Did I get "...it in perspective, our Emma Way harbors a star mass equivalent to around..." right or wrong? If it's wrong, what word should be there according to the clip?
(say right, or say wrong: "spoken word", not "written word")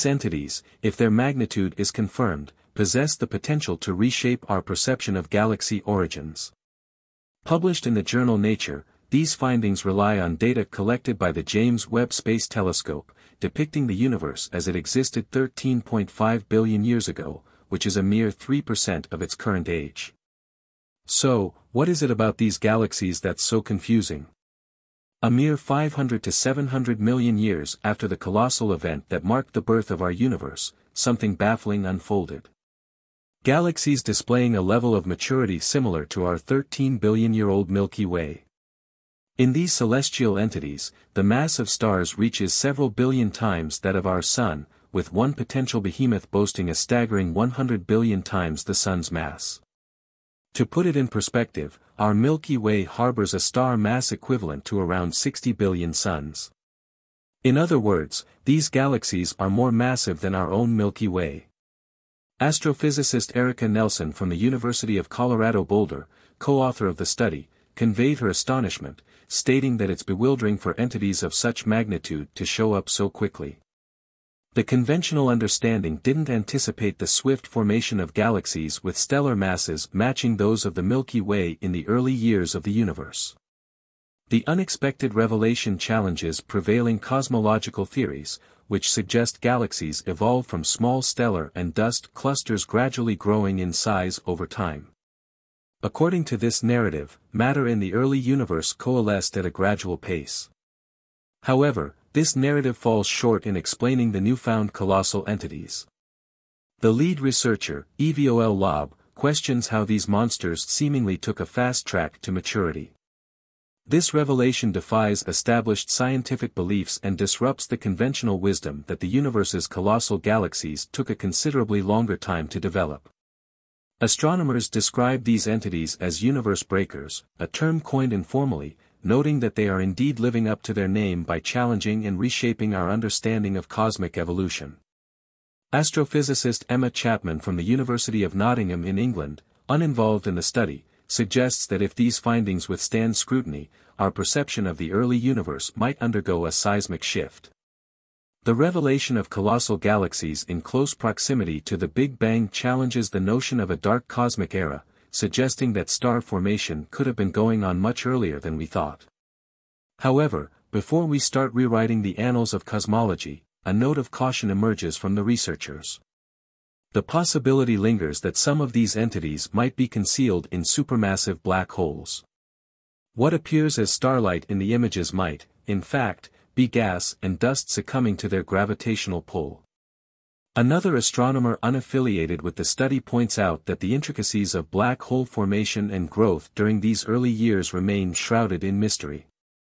wrong: "Milky", not "Emma".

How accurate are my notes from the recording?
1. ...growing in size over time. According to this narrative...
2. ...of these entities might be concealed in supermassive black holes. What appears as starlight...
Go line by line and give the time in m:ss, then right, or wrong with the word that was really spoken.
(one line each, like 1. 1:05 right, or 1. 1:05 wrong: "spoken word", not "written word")
1. 1:33 right
2. 2:48 right.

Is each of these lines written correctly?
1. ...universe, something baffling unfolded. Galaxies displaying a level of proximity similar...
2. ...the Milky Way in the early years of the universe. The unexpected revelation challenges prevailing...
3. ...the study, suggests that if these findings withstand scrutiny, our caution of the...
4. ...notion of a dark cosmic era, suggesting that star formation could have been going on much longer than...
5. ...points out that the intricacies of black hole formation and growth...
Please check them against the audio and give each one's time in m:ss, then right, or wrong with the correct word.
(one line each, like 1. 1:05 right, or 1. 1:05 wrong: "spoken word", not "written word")
1. 0:30 wrong: "maturity", not "proximity"
2. 1:20 right
3. 2:20 wrong: "perception", not "caution"
4. 2:33 wrong: "earlier", not "longer"
5. 3:02 right.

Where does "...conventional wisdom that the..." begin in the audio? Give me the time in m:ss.
1:57.